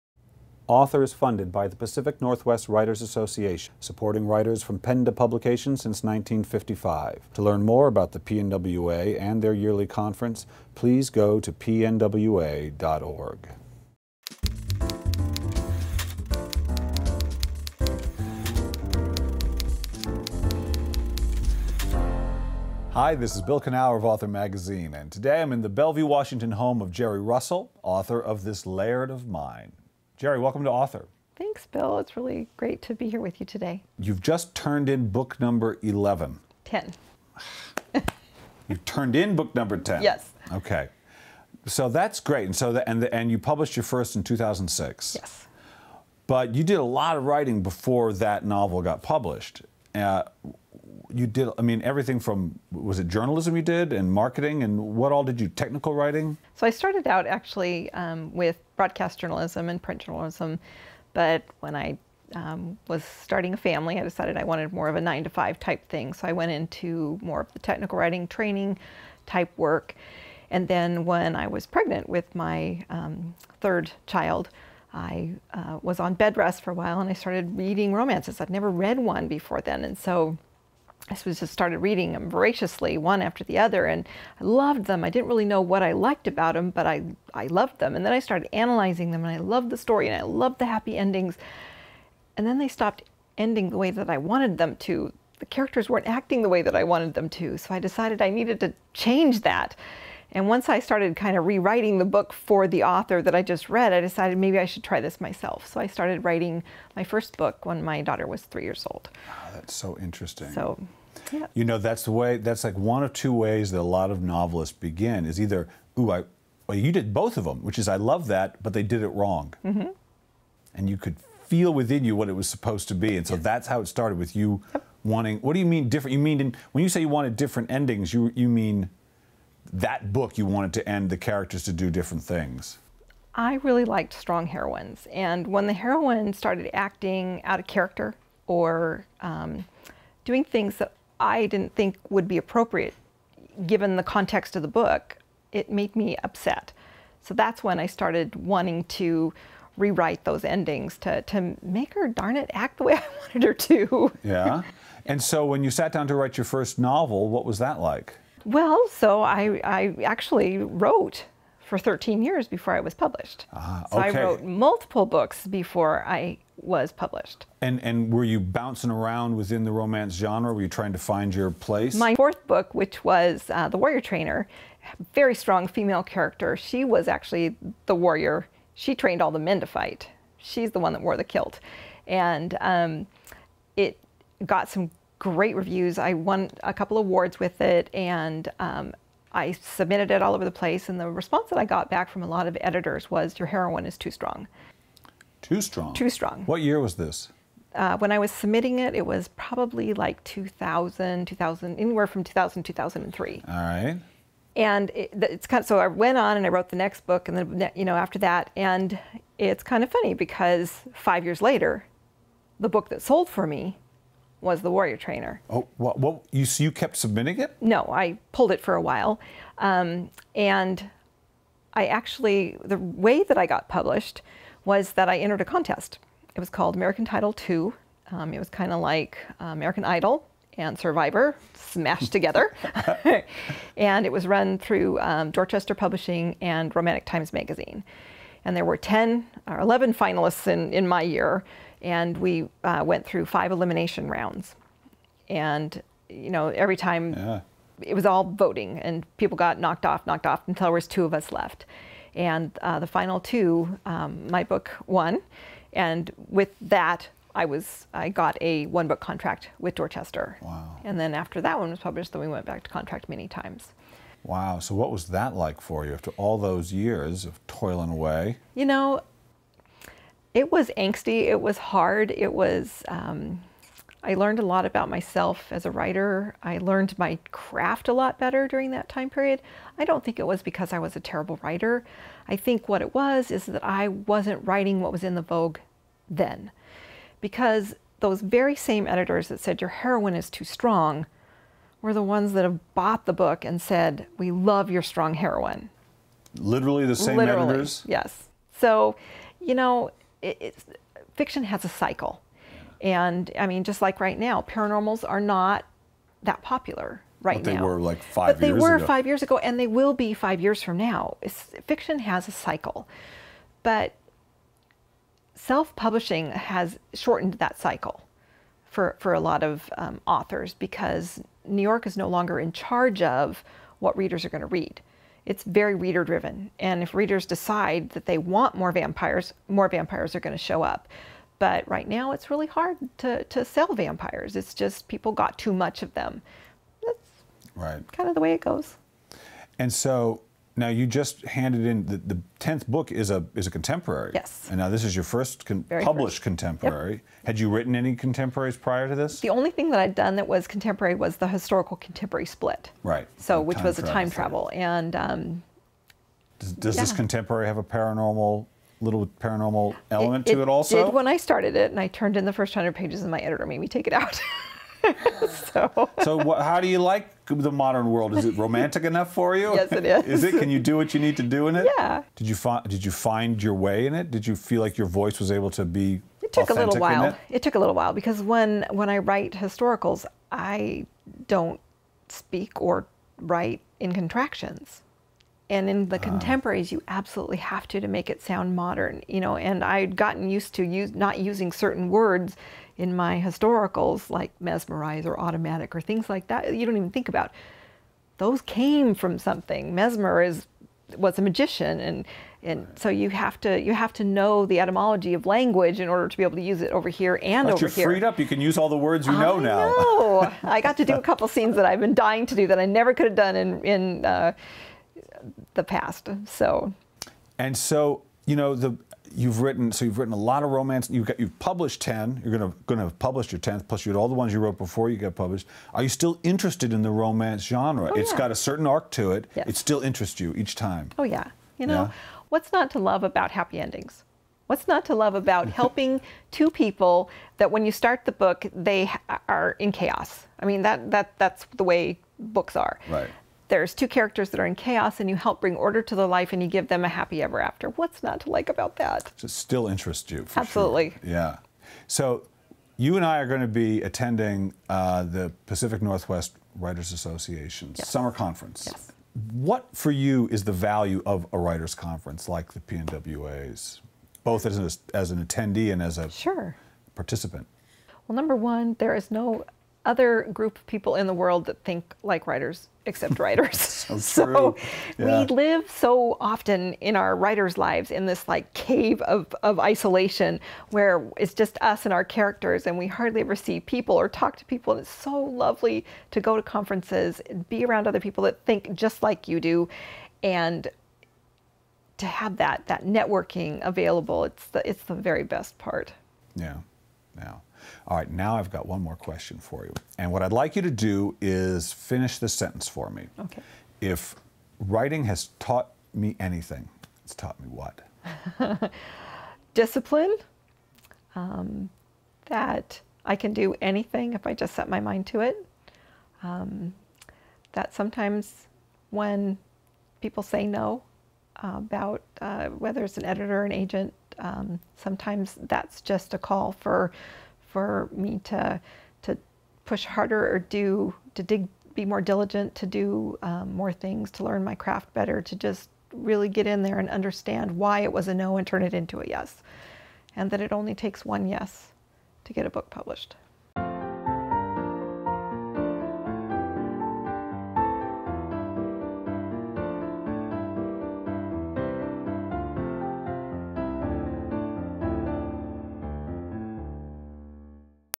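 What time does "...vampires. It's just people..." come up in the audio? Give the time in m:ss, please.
5:33.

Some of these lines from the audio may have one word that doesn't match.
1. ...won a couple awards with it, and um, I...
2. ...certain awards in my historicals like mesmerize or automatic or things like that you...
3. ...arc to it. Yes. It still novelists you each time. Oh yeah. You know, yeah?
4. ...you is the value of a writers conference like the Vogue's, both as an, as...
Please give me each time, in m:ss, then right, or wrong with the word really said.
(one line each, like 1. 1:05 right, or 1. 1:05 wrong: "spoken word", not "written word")
1. 3:06 right
2. 6:31 wrong: "words", not "awards"
3. 7:08 wrong: "interests", not "novelists"
4. 7:39 wrong: "PNWA", not "Vogue".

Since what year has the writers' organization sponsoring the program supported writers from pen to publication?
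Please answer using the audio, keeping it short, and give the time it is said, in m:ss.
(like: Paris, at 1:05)
1955, at 0:06.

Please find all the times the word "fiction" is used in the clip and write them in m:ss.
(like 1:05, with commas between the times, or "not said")
5:01, 5:11.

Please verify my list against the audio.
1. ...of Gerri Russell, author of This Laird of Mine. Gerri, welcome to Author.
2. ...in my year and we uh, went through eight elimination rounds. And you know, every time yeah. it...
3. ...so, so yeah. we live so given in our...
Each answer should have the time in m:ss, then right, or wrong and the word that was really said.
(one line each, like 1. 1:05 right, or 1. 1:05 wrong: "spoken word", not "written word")
1. 0:26 right
2. 4:00 wrong: "five", not "eight"
3. 7:53 wrong: "often", not "given".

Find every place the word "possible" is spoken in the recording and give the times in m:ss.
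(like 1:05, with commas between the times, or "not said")
not said.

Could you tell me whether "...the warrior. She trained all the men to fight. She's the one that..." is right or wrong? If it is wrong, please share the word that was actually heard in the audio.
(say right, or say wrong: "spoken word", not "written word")
right.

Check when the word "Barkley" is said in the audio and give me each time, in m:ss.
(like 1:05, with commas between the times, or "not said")
not said.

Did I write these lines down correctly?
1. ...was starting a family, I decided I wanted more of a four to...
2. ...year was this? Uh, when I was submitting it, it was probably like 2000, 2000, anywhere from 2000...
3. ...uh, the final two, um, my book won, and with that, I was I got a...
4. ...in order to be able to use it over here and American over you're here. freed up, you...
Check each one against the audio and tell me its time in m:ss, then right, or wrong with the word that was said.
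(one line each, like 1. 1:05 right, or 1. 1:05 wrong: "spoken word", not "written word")
1. 1:02 wrong: "nine", not "four"
2. 3:16 right
3. 4:12 right
4. 6:45 wrong: "Once", not "American".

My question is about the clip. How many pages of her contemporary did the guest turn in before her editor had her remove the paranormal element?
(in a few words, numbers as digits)
100.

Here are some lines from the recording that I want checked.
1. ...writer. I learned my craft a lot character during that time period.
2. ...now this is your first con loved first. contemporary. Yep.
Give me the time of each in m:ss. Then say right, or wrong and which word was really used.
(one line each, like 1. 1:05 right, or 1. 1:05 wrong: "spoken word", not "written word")
1. 4:35 wrong: "better", not "character"
2. 5:44 wrong: "published", not "loved".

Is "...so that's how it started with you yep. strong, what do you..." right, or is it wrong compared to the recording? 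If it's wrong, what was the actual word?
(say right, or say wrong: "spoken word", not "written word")
wrong: "wanting", not "strong".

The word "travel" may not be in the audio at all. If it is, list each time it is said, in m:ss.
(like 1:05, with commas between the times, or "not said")
5:54.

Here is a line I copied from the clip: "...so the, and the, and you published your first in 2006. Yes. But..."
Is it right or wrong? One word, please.
right.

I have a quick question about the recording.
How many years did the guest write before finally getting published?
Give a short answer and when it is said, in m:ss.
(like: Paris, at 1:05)
13, at 2:41.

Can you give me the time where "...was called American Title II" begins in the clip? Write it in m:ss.
3:46.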